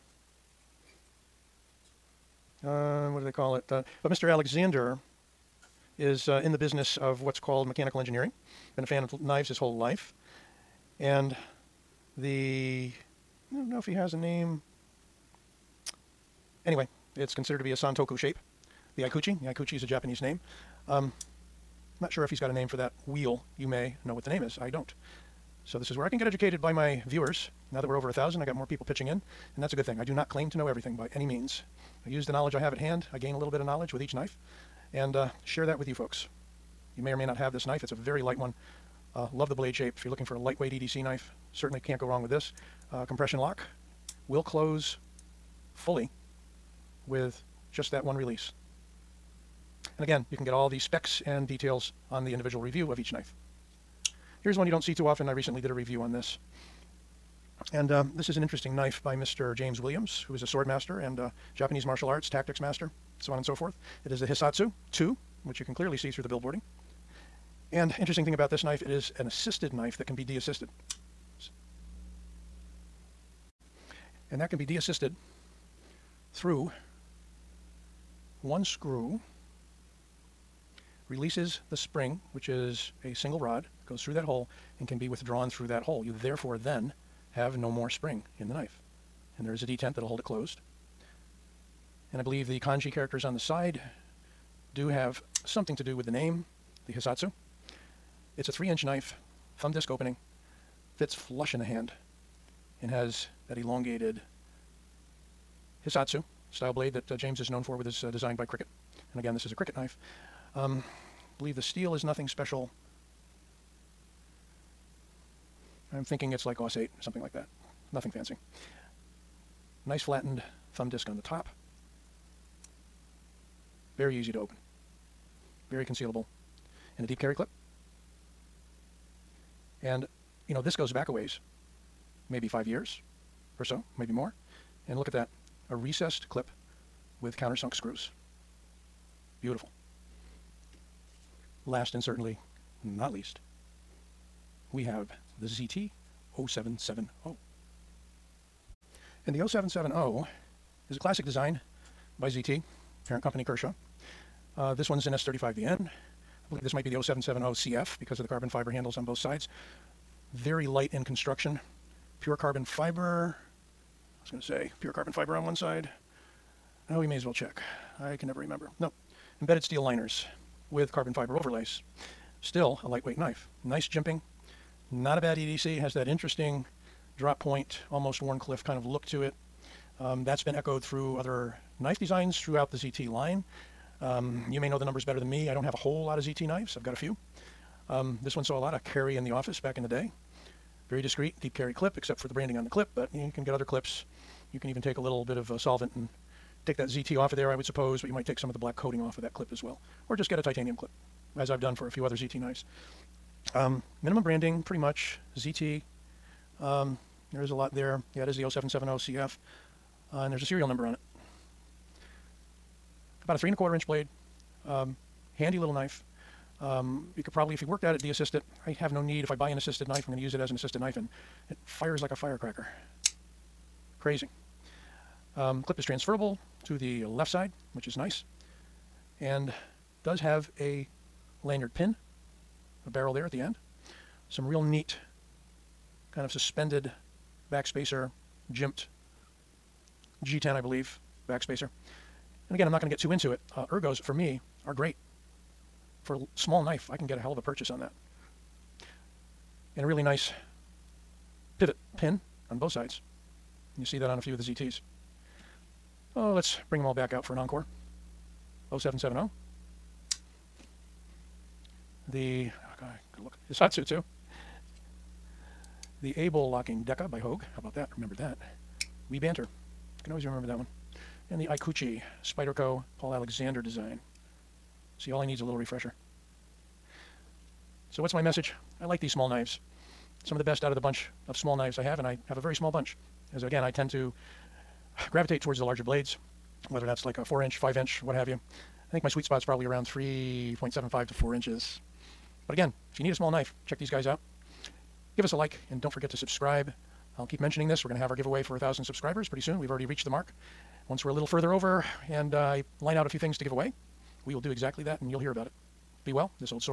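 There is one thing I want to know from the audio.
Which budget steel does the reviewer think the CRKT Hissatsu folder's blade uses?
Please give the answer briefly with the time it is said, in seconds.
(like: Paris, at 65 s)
AUS 8, at 116 s.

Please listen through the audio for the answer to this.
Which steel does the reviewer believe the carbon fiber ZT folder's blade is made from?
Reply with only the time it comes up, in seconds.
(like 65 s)
155 s.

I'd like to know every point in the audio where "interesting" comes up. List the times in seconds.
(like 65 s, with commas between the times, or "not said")
58 s, 67 s, 176 s.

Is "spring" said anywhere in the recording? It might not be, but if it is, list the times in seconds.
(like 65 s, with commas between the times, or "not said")
81 s, 87 s.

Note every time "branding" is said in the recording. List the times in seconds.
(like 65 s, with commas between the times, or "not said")
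192 s, 204 s.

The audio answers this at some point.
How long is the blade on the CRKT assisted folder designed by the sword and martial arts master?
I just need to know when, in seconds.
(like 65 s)
98 s.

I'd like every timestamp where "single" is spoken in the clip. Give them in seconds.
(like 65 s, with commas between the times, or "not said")
83 s.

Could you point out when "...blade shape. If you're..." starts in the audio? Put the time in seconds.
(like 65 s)
39 s.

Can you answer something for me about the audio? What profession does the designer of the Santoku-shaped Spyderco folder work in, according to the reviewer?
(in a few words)
mechanical engineering.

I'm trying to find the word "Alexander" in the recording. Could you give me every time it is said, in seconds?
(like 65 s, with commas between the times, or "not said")
4 s, 273 s.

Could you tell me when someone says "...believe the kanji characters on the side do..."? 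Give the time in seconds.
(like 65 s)
92 s.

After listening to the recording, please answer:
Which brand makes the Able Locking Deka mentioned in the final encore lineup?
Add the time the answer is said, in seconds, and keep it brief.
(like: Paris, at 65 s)
Hogue, at 267 s.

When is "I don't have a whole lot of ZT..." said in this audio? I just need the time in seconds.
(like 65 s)
185 s.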